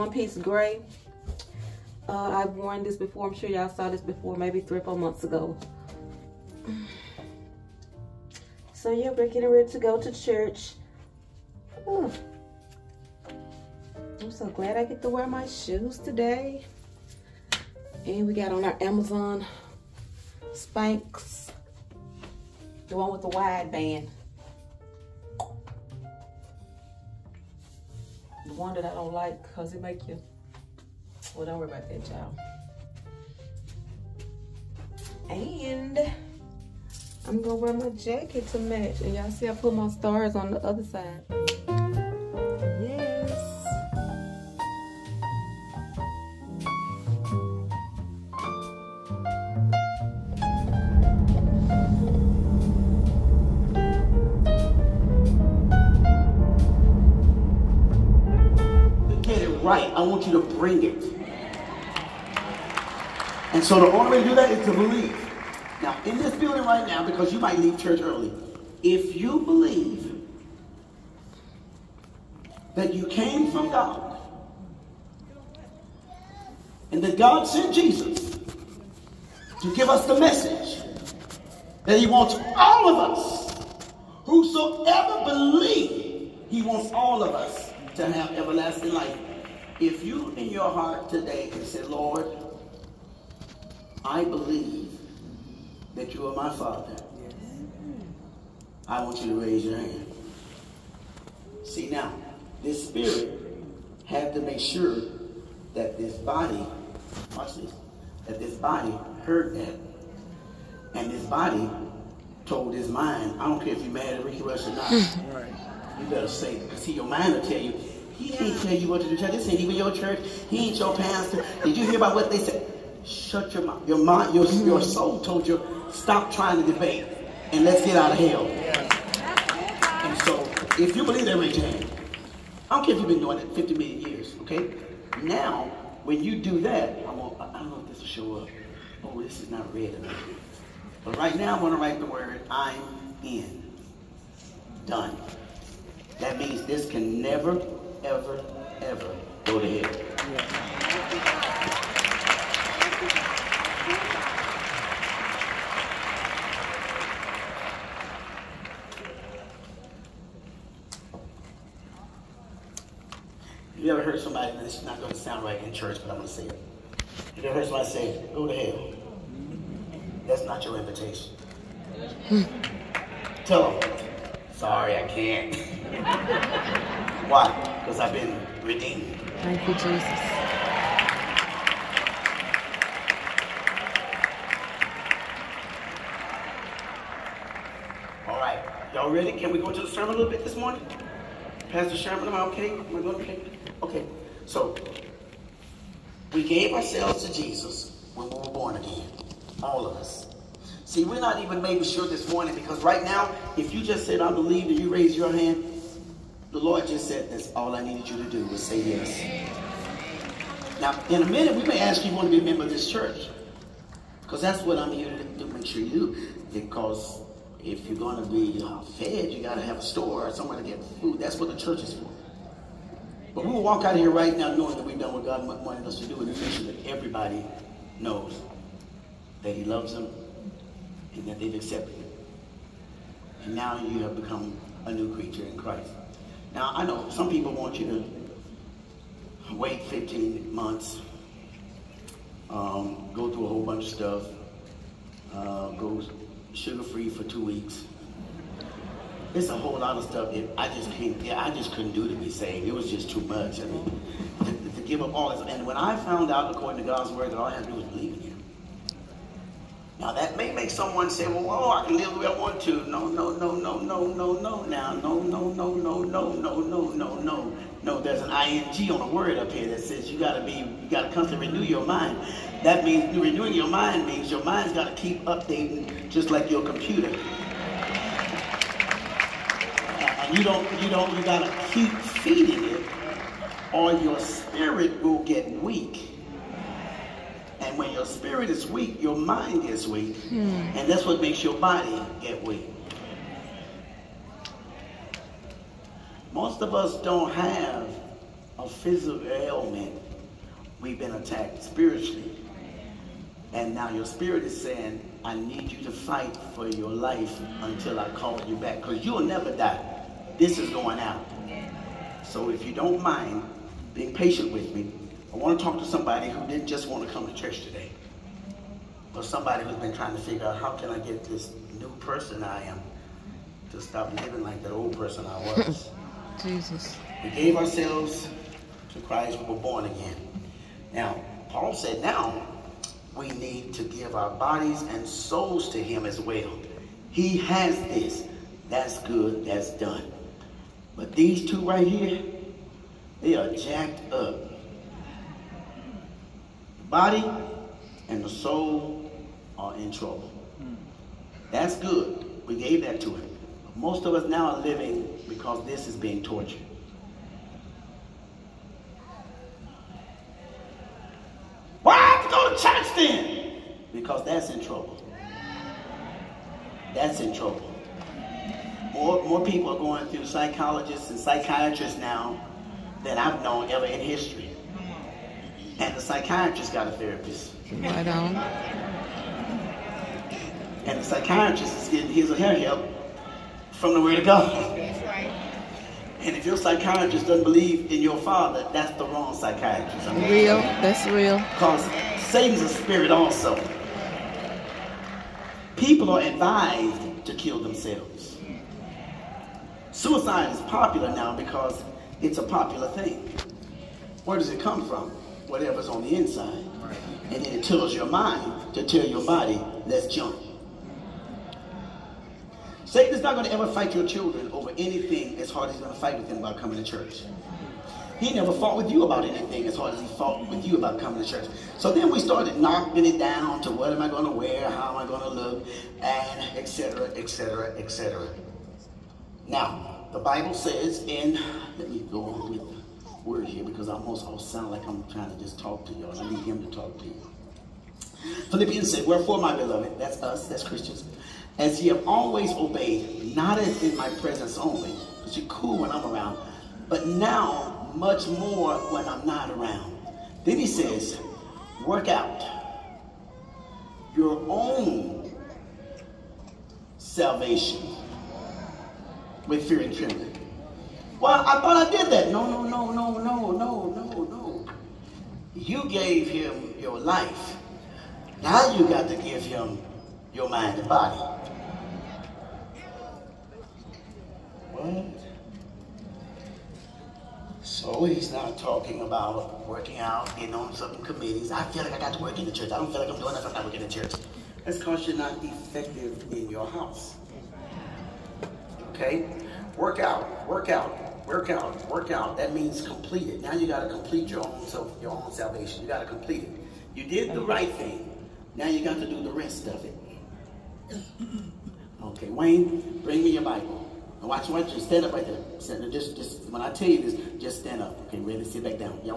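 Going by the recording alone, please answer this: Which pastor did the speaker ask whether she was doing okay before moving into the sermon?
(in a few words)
Pastor Sherman.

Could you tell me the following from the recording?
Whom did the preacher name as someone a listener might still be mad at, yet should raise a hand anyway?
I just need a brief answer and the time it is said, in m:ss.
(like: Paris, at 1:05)
Ricky Rush, at 1:54.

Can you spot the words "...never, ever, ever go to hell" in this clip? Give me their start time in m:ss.
2:27.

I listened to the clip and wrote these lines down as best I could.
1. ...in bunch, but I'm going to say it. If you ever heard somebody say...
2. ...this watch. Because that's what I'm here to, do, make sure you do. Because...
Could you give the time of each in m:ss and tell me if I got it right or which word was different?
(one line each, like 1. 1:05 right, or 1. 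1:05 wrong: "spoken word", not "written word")
1. 2:45 wrong: "church", not "bunch"
2. 3:32 wrong: "church", not "watch".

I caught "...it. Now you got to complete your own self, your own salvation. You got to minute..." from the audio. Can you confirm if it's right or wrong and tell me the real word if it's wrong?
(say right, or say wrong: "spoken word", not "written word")
wrong: "complete", not "minute".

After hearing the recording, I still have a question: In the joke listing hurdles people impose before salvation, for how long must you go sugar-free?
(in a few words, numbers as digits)
two weeks.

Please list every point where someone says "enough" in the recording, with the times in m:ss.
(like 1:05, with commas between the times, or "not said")
2:19, 8:03.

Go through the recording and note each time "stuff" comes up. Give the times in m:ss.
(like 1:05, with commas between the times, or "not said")
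4:03, 4:10.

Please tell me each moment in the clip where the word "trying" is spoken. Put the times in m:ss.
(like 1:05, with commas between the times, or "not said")
2:06, 5:19, 7:15.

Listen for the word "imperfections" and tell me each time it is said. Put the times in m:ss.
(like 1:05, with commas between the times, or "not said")
not said.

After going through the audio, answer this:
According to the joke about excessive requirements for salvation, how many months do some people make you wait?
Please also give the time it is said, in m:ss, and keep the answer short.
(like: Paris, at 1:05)
15, at 3:59.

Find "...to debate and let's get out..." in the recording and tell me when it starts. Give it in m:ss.
2:06.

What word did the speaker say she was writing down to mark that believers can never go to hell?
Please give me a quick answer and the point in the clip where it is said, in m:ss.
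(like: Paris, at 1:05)
I'm in, at 2:22.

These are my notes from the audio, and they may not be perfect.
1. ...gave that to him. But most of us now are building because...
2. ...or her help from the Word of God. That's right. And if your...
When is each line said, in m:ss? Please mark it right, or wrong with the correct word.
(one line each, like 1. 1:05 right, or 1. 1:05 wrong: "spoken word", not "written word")
1. 5:52 wrong: "living", not "building"
2. 6:22 right.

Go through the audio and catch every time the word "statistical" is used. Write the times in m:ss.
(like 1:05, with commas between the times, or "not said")
not said.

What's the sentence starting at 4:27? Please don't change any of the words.
No, there's an ing on a word up here that says you got to be, you got to constantly renew your mind.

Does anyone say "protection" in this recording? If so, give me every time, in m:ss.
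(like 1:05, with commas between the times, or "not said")
not said.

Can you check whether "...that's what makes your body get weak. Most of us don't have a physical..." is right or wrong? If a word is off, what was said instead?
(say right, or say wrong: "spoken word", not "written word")
right.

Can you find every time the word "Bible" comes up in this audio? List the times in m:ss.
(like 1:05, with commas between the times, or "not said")
7:10, 8:23.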